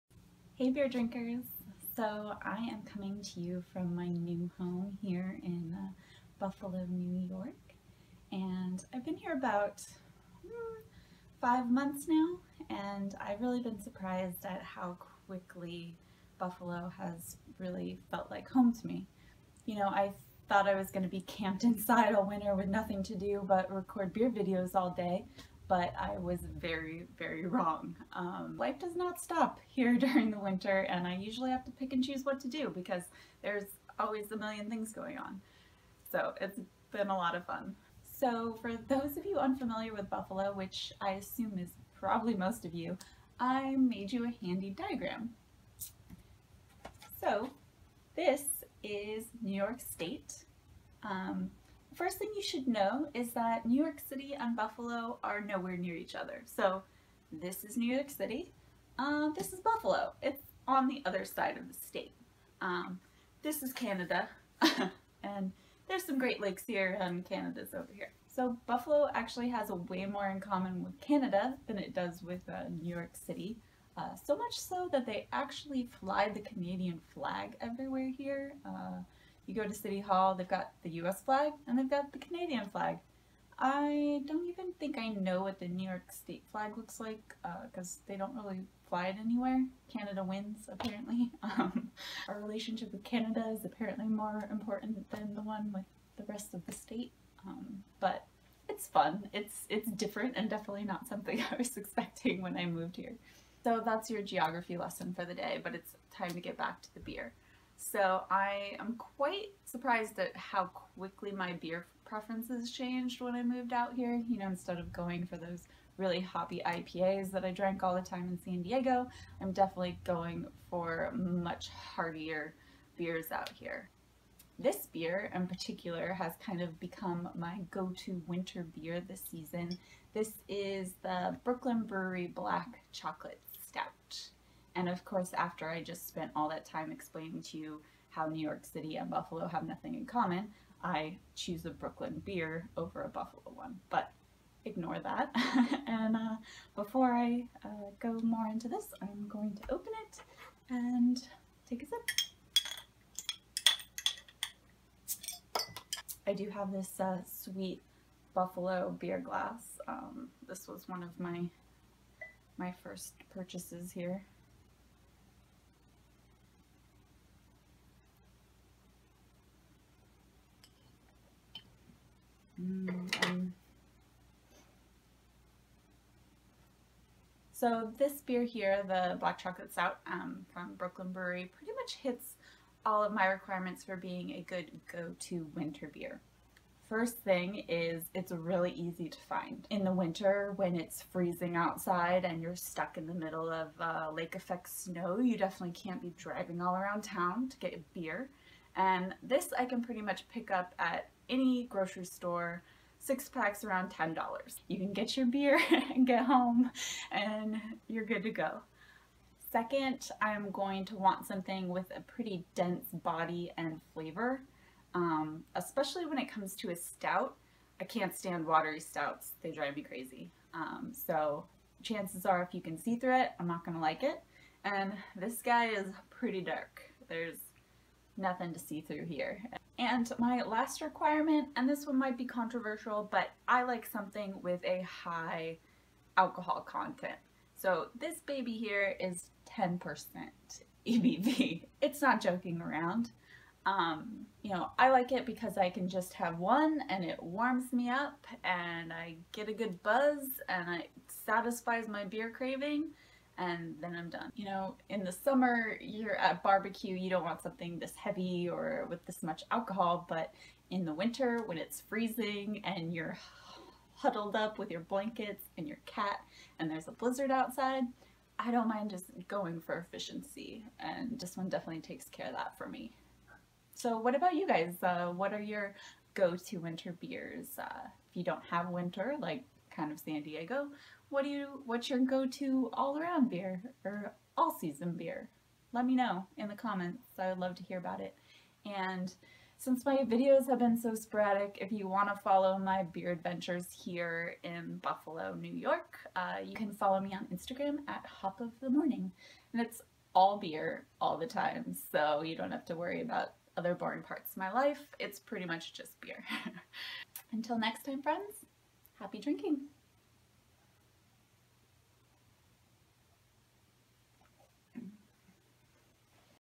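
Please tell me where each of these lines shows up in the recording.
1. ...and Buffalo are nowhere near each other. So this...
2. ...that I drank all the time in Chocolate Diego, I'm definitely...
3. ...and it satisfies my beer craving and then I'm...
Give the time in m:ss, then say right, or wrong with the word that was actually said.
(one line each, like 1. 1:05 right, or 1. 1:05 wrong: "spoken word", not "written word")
1. 0:54 right
2. 1:57 wrong: "San", not "Chocolate"
3. 4:10 right.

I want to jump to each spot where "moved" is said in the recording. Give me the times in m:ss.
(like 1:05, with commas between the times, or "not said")
1:42, 1:53.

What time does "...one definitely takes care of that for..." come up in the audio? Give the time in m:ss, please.
4:31.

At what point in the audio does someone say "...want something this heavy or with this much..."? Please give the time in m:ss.
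4:17.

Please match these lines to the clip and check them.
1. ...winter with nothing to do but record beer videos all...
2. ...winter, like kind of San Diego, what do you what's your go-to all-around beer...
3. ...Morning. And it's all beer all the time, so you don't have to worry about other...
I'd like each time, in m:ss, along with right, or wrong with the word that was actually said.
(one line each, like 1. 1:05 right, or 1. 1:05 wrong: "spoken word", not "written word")
1. 0:22 right
2. 4:38 right
3. 4:58 right.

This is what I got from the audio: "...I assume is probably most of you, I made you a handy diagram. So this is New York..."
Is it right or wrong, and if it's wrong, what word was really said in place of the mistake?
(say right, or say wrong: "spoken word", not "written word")
right.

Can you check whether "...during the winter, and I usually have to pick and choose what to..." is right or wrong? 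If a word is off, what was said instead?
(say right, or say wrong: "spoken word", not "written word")
right.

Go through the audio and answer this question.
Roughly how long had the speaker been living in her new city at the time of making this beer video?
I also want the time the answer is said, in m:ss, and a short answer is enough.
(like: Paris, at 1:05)
5 months, at 0:11.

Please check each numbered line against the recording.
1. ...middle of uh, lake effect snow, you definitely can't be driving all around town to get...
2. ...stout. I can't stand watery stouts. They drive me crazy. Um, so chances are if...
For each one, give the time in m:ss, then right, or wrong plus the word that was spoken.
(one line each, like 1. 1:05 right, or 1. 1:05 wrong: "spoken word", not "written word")
1. 3:13 right
2. 3:36 right.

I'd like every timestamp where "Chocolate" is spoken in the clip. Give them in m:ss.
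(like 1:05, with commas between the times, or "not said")
2:12, 2:59.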